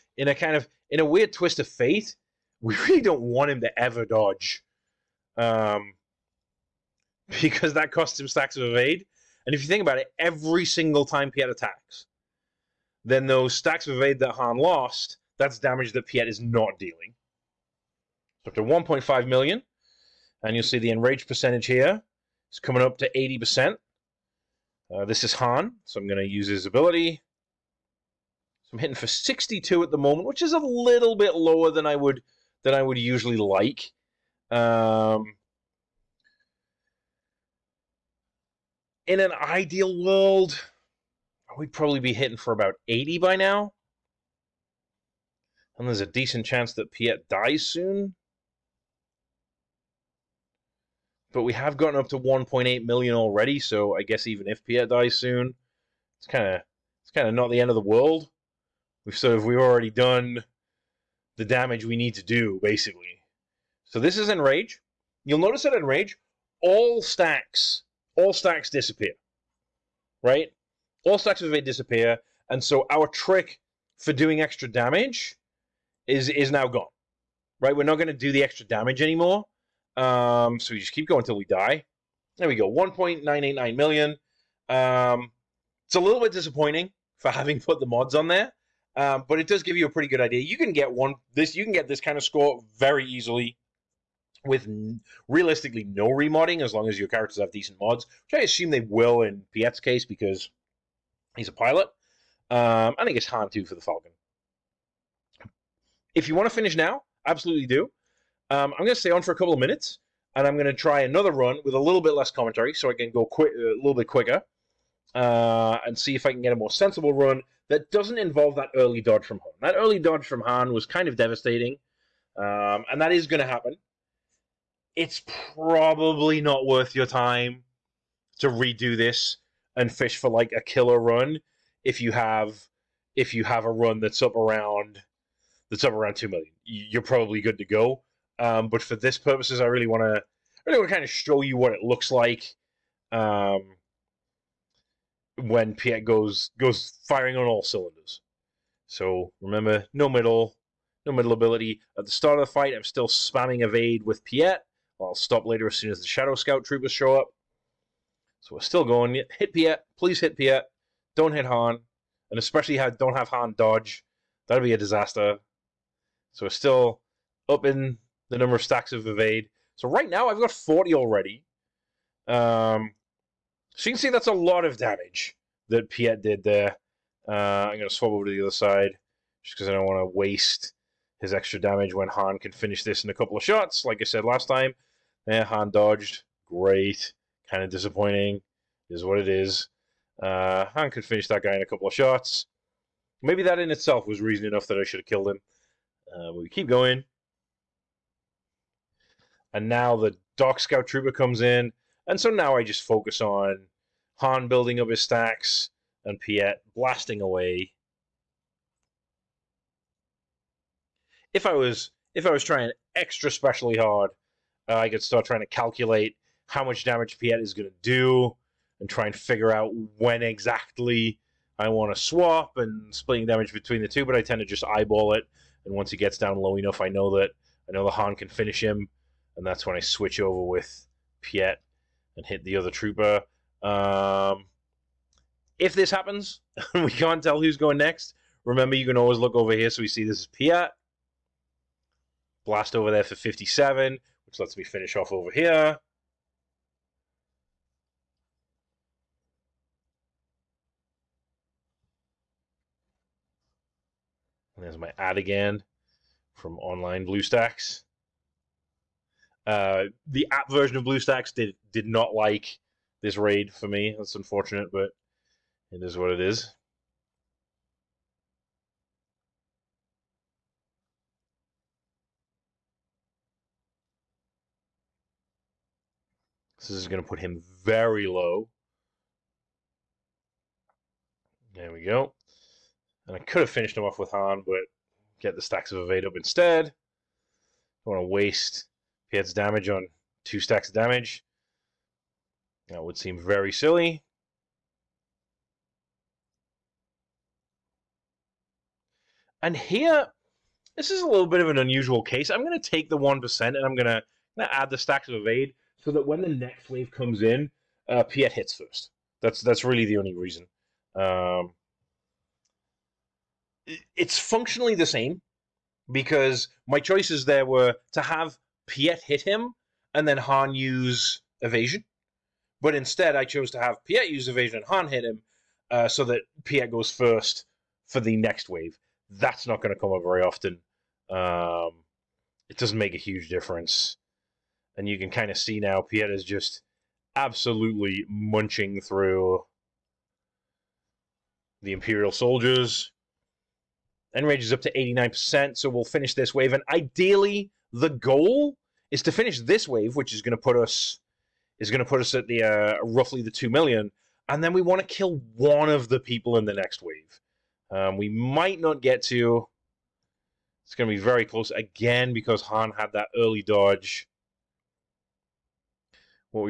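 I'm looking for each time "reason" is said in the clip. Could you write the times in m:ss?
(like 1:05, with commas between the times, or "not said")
3:14, 5:10.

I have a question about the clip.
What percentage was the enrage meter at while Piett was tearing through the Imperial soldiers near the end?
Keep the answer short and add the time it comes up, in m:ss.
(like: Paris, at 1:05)
89%, at 5:44.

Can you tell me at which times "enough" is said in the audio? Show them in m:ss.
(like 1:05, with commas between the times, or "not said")
3:14, 3:46.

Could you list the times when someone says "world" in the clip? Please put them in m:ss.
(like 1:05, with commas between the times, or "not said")
0:40, 0:57.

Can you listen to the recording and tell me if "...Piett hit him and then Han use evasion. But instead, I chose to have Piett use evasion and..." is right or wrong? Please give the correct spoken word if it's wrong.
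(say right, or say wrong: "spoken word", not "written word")
right.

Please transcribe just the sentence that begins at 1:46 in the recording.
If you want to finish now, absolutely do.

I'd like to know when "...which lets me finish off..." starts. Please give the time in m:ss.
4:04.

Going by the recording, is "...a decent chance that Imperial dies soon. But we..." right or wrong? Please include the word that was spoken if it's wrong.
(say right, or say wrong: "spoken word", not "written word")
wrong: "Piett", not "Imperial".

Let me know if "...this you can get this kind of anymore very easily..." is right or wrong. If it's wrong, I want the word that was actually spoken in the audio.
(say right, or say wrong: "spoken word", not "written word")
wrong: "score", not "anymore".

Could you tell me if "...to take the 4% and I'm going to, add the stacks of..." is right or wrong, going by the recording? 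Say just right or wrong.
wrong.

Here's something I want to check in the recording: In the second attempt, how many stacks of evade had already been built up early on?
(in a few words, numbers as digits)
40.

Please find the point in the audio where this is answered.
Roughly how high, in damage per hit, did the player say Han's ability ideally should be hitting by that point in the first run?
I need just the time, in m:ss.
0:42.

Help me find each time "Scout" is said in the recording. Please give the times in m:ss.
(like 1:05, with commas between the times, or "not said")
2:36, 3:20.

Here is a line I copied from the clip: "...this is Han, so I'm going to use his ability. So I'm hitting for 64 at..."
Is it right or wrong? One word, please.
wrong.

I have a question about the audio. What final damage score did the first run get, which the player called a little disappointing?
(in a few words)
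1.989 million.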